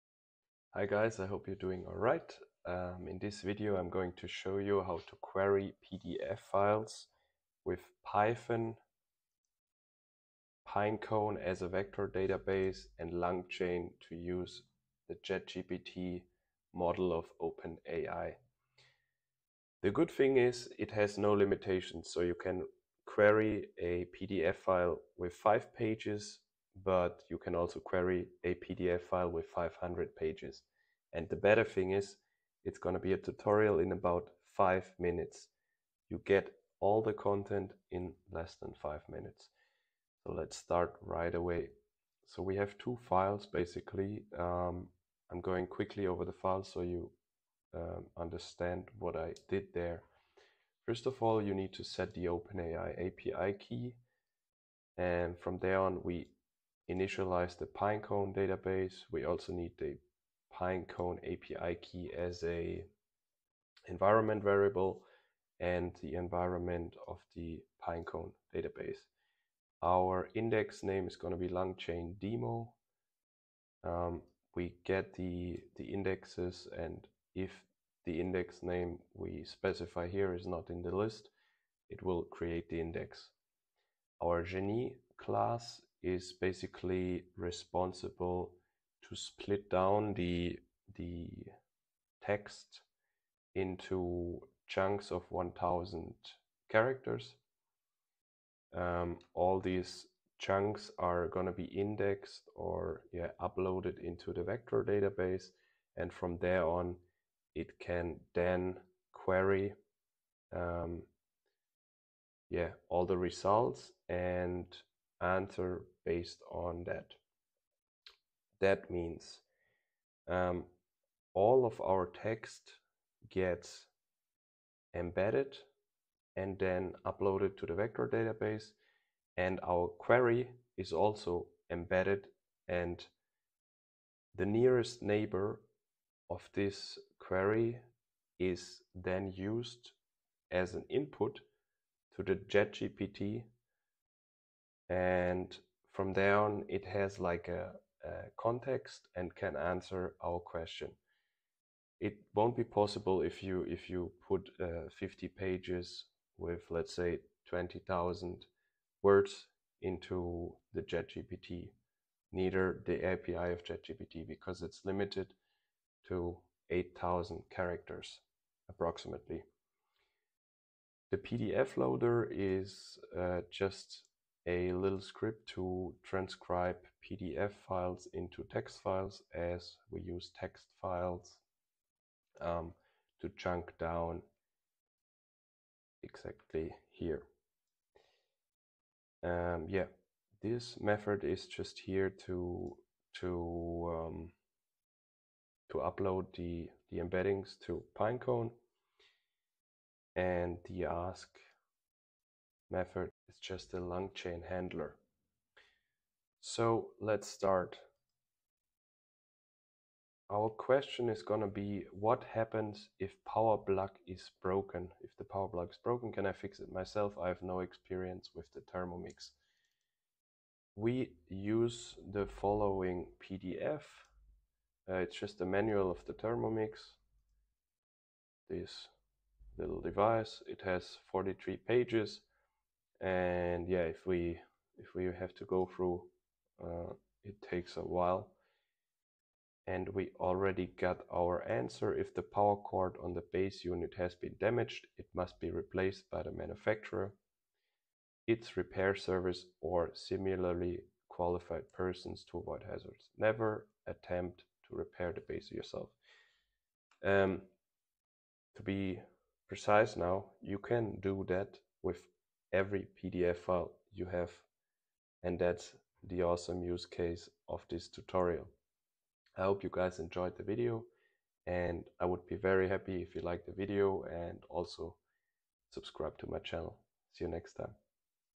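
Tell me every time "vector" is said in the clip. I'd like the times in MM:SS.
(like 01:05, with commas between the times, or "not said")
00:11, 01:44, 02:07.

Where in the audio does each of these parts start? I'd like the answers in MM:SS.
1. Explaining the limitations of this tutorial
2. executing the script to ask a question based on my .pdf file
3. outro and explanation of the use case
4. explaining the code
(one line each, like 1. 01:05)
1. 00:20
2. 03:25
3. 04:20
4. 00:40.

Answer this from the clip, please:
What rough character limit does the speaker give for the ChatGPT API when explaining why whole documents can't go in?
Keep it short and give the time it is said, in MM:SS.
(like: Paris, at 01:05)
8,000, at 02:46.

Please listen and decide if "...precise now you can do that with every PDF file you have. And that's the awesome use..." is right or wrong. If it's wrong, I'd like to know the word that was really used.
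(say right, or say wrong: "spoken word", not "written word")
right.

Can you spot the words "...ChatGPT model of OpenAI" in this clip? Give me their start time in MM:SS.
00:15.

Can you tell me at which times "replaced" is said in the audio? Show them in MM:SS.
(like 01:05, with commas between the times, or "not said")
04:05.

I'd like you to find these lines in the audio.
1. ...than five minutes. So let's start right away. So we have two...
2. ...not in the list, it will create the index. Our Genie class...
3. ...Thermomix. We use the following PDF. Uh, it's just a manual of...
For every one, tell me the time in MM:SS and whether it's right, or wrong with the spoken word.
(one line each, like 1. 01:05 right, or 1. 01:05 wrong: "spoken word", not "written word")
1. 00:38 right
2. 01:20 right
3. 03:38 right.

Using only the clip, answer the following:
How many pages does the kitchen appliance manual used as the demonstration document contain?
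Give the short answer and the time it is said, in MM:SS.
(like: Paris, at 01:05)
43, at 03:51.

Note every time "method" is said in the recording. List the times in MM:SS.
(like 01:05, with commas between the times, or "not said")
03:10, 03:22.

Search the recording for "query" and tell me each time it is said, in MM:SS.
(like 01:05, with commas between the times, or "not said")
00:05, 00:23, 00:27, 01:49, 02:09, 02:17.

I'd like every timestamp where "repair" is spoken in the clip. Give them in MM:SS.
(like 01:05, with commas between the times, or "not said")
04:08, 04:14.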